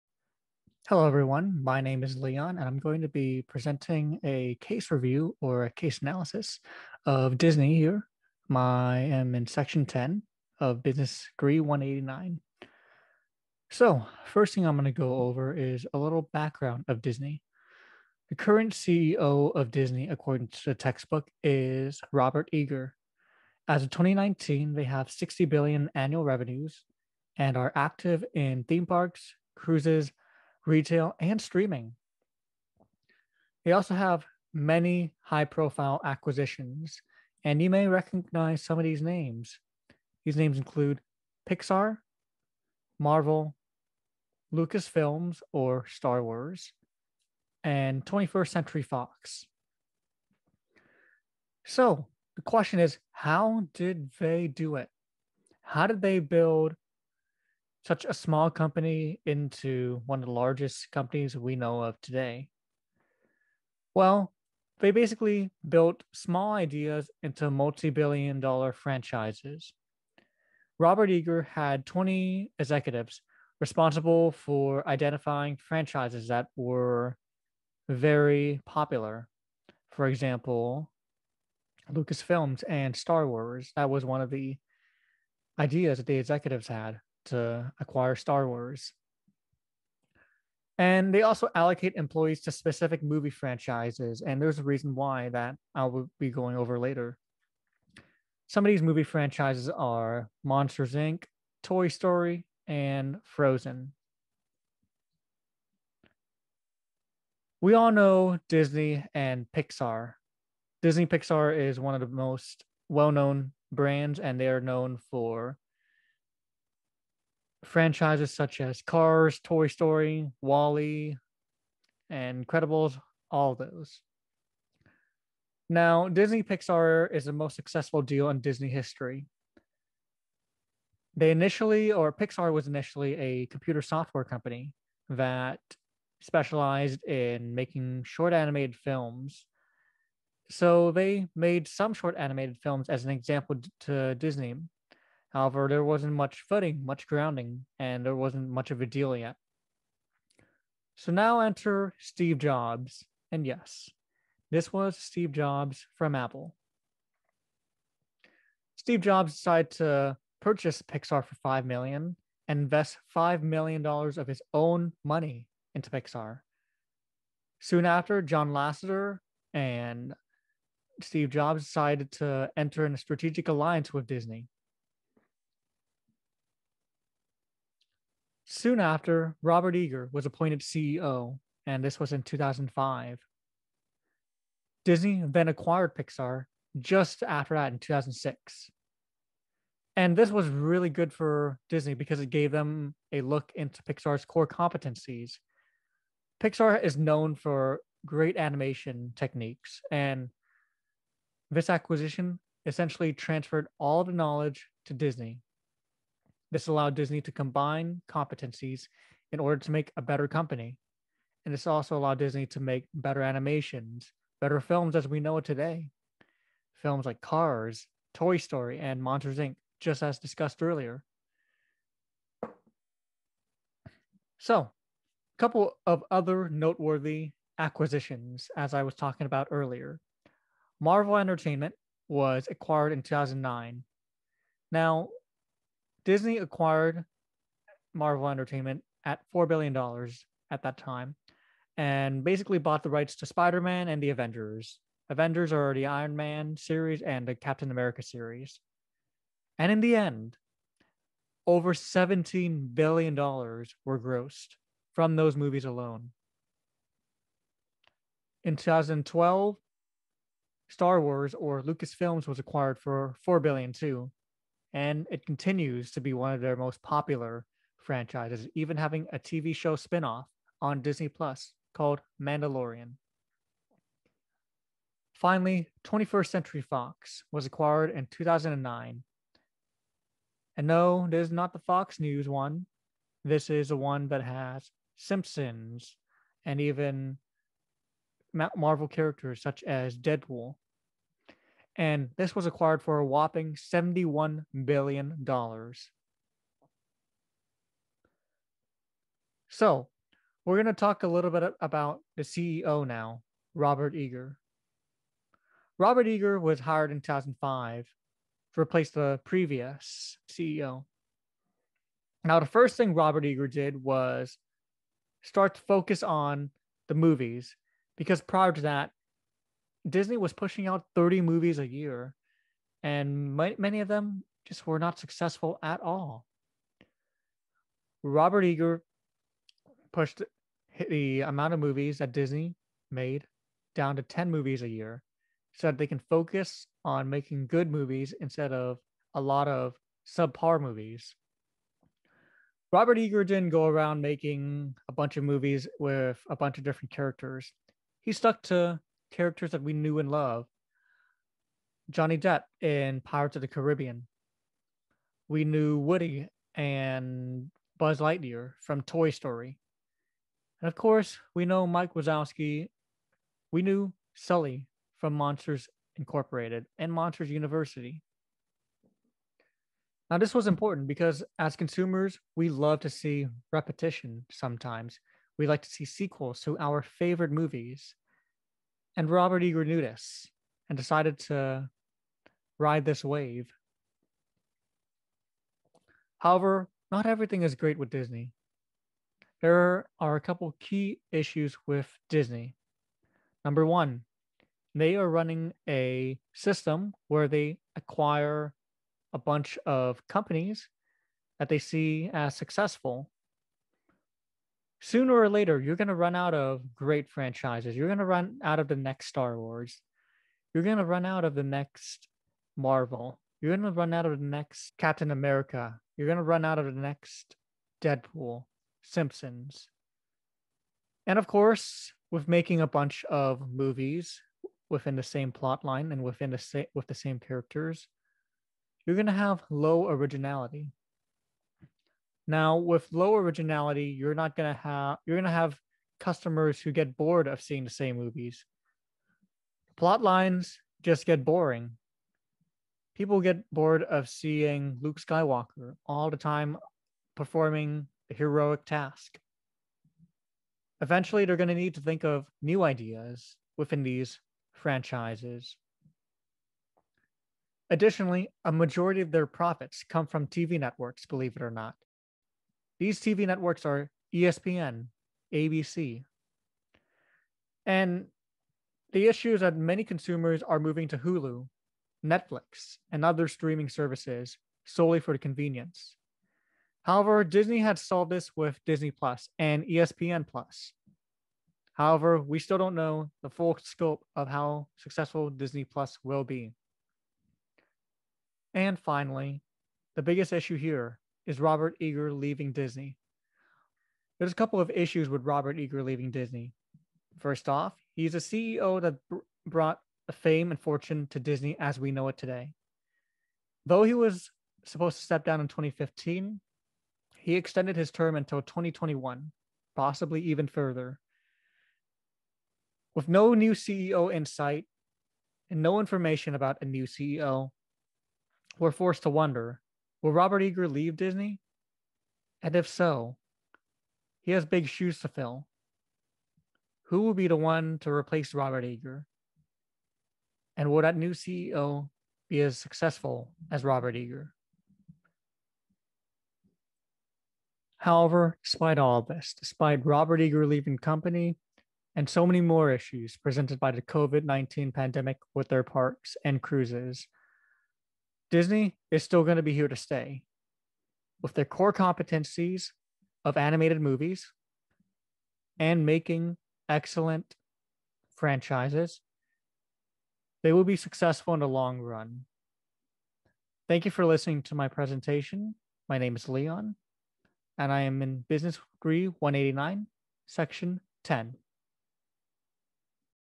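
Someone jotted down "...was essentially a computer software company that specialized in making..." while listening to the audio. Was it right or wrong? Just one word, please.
wrong.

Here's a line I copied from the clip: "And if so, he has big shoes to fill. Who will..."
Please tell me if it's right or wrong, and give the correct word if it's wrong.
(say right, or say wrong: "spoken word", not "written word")
right.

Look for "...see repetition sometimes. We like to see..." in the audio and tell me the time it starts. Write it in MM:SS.
06:12.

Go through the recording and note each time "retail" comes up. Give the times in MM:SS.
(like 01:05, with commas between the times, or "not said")
00:30.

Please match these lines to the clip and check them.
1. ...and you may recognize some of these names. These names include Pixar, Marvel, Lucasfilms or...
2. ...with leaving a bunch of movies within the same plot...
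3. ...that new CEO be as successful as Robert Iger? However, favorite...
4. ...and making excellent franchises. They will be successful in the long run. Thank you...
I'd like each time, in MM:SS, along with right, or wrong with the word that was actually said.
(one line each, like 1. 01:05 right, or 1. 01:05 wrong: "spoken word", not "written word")
1. 00:37 right
2. 07:02 wrong: "making", not "leaving"
3. 08:50 wrong: "despite", not "favorite"
4. 09:15 right.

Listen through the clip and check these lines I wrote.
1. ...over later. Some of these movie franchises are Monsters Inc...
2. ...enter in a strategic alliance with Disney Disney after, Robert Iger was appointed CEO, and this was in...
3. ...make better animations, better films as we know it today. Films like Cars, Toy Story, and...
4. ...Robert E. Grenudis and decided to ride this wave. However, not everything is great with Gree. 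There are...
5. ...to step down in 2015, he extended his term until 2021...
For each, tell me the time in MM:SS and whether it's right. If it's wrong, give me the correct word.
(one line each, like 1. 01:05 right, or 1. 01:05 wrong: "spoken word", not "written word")
1. 01:36 right
2. 02:52 wrong: "Soon", not "Disney"
3. 03:32 right
4. 06:19 wrong: "Disney", not "Gree"
5. 08:24 right.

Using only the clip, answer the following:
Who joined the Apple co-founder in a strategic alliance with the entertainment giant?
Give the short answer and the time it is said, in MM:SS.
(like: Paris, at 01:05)
John Lasseter, at 02:48.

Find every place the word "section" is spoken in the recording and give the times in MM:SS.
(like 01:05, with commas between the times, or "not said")
00:09, 09:30.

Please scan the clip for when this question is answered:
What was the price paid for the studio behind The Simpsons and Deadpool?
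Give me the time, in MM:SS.
04:53.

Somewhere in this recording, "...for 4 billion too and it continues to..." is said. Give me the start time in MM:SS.
04:22.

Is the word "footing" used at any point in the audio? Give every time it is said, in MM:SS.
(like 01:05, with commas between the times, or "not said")
02:26.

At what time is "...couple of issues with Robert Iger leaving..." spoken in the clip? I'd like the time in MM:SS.
08:14.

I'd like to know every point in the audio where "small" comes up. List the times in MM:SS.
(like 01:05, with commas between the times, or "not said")
00:58, 01:06.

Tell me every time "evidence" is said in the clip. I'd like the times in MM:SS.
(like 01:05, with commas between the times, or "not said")
not said.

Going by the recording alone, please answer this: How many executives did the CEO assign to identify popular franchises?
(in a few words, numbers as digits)
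20.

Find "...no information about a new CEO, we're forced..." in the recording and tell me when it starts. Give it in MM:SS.
08:35.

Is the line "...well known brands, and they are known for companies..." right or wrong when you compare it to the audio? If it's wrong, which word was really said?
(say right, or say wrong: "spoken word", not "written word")
wrong: "franchises", not "companies".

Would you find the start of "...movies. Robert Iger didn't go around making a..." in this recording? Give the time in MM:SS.
05:40.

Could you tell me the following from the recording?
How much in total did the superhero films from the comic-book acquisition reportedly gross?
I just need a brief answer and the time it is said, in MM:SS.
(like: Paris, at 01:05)
over $17 billion, at 04:11.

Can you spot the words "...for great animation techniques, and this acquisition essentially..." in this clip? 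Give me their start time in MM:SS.
03:17.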